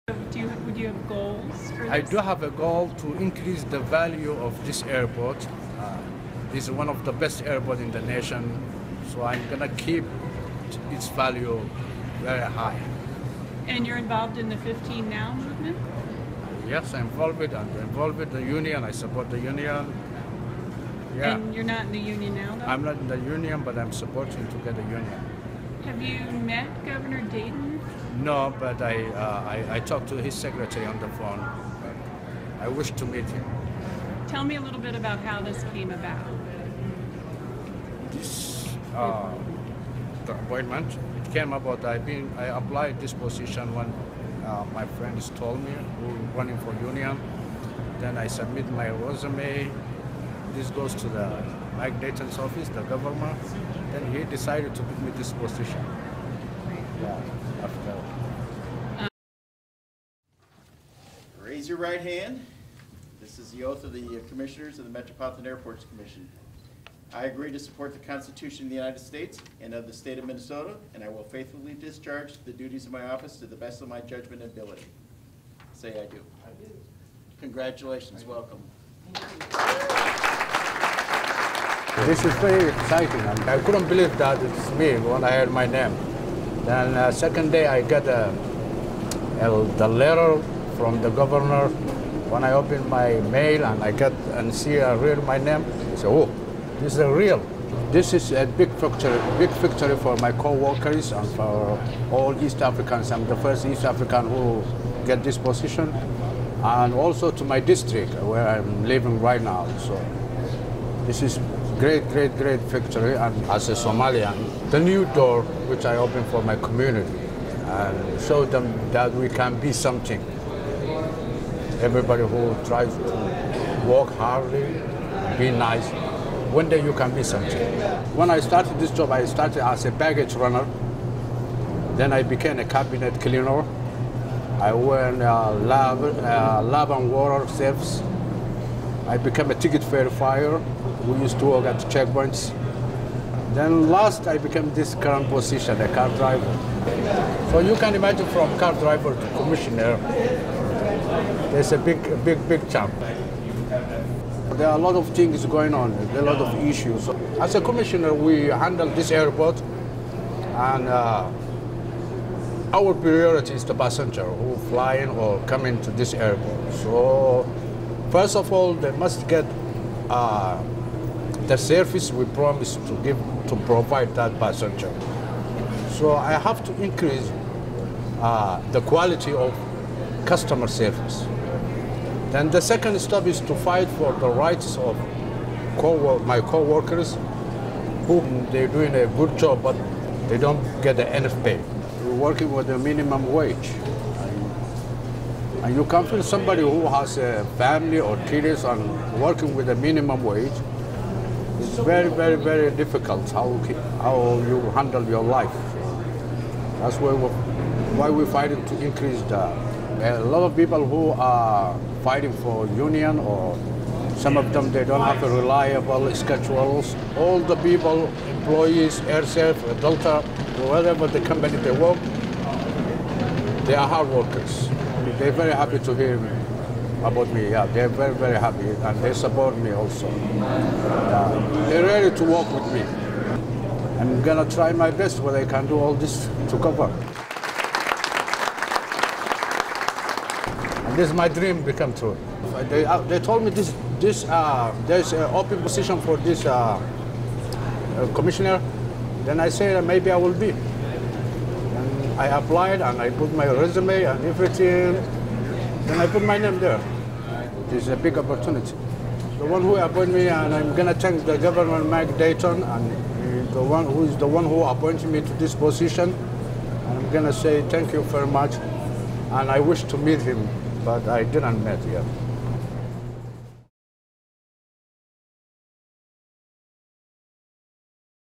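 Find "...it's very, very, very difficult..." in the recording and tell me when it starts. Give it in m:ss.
3:21.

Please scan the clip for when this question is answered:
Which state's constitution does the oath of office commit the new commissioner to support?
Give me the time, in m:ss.
1:10.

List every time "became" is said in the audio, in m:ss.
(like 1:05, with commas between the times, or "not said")
2:12, 2:19, 2:24.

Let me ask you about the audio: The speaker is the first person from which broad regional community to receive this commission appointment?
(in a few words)
East African.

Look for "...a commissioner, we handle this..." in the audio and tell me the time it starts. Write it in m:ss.
2:37.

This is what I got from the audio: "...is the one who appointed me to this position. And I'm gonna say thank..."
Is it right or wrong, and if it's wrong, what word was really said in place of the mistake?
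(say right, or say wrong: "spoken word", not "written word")
right.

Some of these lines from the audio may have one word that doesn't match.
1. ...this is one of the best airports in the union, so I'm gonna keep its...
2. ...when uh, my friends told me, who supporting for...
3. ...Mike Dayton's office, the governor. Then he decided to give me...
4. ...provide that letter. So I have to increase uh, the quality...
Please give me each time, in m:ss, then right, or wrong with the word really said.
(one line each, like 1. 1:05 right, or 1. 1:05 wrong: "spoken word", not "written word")
1. 0:06 wrong: "nation", not "union"
2. 0:43 wrong: "running", not "supporting"
3. 0:51 right
4. 2:53 wrong: "passenger", not "letter".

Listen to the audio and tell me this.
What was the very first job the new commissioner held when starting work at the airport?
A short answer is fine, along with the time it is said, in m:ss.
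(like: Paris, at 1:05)
Baggage runner, at 2:09.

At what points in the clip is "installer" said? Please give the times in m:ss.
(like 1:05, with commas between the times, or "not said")
not said.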